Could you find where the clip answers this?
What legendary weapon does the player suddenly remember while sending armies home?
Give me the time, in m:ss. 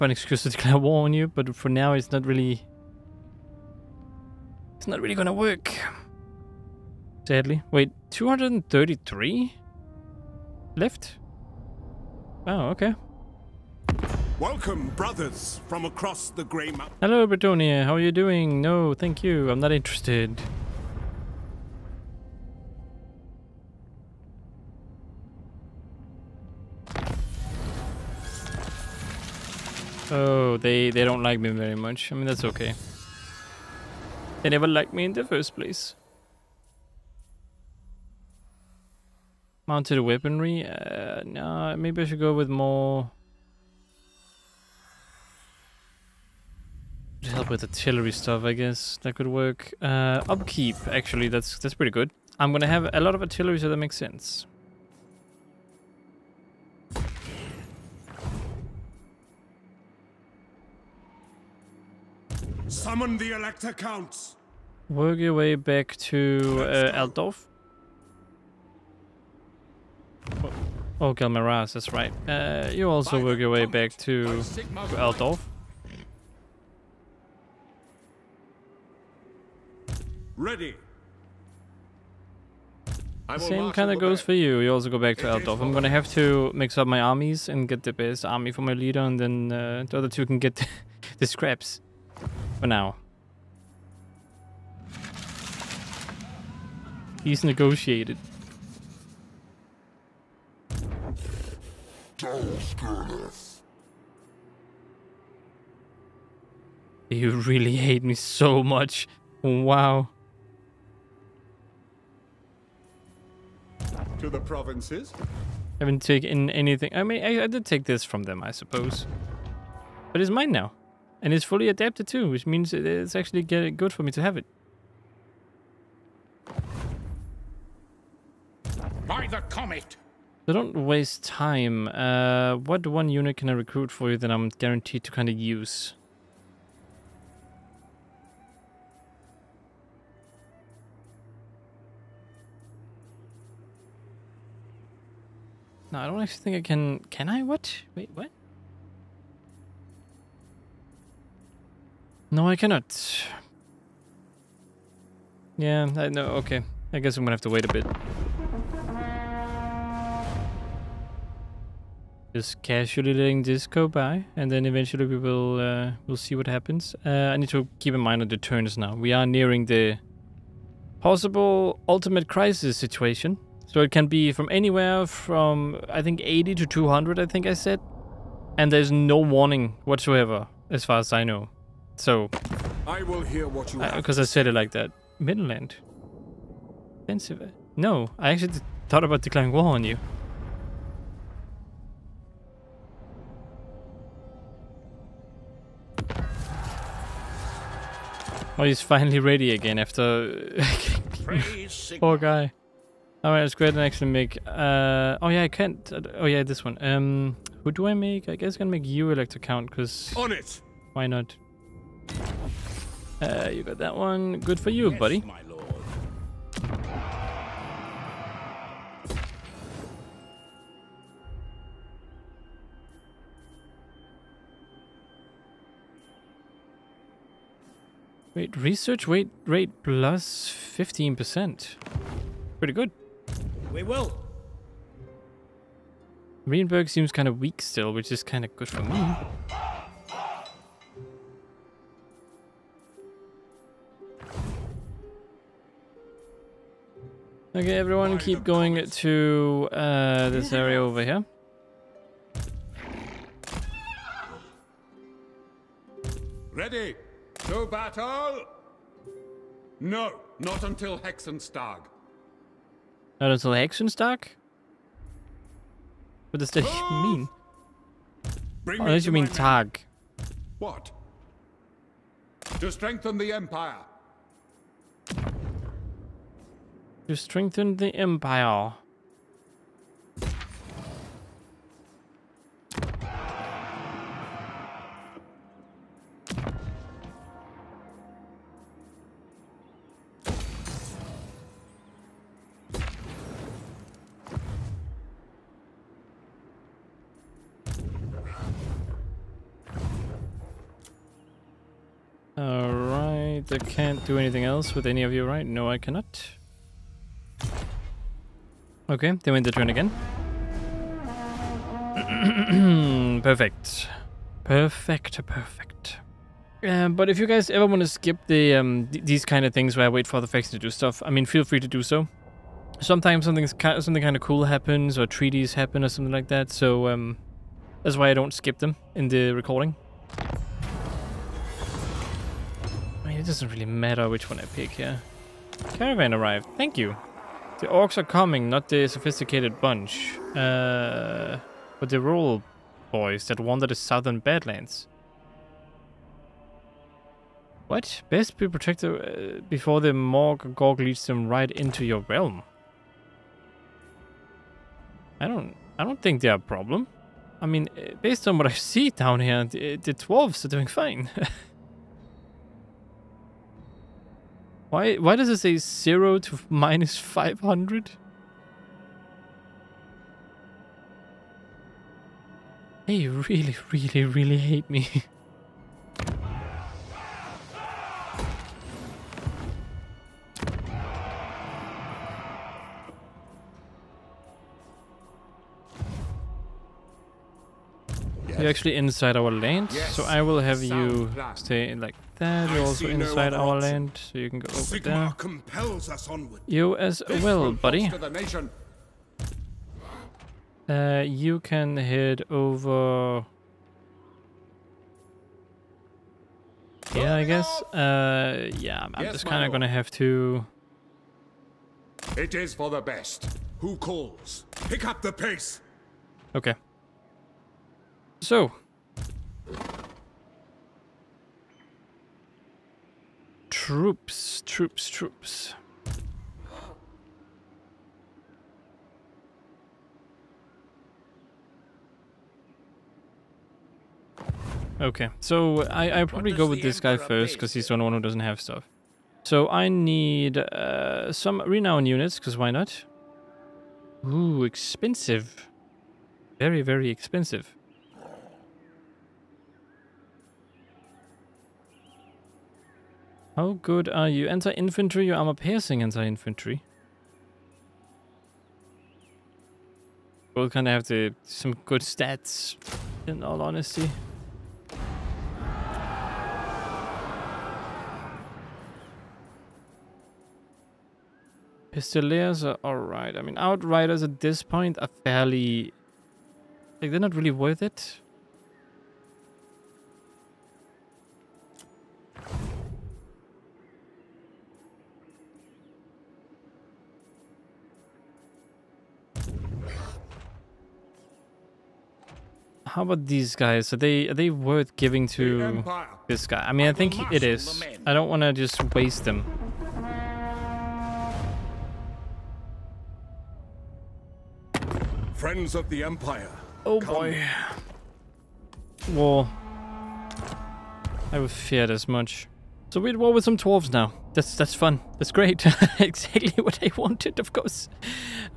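1:11.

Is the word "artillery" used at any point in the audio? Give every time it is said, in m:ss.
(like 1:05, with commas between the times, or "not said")
0:47, 0:53.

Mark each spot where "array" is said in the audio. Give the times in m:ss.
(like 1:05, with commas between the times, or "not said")
not said.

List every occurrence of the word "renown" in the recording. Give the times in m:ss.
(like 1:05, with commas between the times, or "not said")
7:21.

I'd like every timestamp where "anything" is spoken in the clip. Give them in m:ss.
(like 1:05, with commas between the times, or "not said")
1:56, 5:04.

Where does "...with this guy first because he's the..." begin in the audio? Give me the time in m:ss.
7:16.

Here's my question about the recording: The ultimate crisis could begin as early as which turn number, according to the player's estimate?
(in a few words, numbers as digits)
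80.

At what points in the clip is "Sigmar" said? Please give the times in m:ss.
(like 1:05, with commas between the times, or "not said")
6:34.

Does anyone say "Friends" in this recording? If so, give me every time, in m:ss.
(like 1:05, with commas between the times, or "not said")
8:25.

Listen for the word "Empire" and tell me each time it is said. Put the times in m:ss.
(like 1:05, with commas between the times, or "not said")
4:33, 4:37, 8:25.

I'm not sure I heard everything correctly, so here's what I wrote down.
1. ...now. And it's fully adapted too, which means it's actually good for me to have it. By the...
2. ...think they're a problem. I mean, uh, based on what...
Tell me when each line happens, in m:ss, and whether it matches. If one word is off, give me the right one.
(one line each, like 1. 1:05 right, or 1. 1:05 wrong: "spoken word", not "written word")
1. 2:00 right
2. 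5:56 right.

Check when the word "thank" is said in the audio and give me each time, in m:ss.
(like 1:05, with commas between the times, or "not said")
0:18, 5:36.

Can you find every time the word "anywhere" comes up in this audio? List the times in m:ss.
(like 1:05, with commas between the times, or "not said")
2:54.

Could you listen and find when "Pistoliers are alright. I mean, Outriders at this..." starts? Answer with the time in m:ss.
7:51.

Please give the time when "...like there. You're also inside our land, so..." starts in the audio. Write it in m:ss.
6:31.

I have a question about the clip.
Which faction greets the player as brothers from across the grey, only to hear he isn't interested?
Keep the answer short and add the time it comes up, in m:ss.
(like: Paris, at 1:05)
Bretonnia, at 0:17.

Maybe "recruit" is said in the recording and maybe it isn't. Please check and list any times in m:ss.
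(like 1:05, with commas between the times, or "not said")
2:13.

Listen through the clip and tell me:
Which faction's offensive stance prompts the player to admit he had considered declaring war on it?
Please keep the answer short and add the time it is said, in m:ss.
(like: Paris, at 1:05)
Middenland, at 3:05.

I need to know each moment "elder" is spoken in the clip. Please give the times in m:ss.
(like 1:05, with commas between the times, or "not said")
not said.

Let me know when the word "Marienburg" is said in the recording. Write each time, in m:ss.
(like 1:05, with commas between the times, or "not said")
3:56.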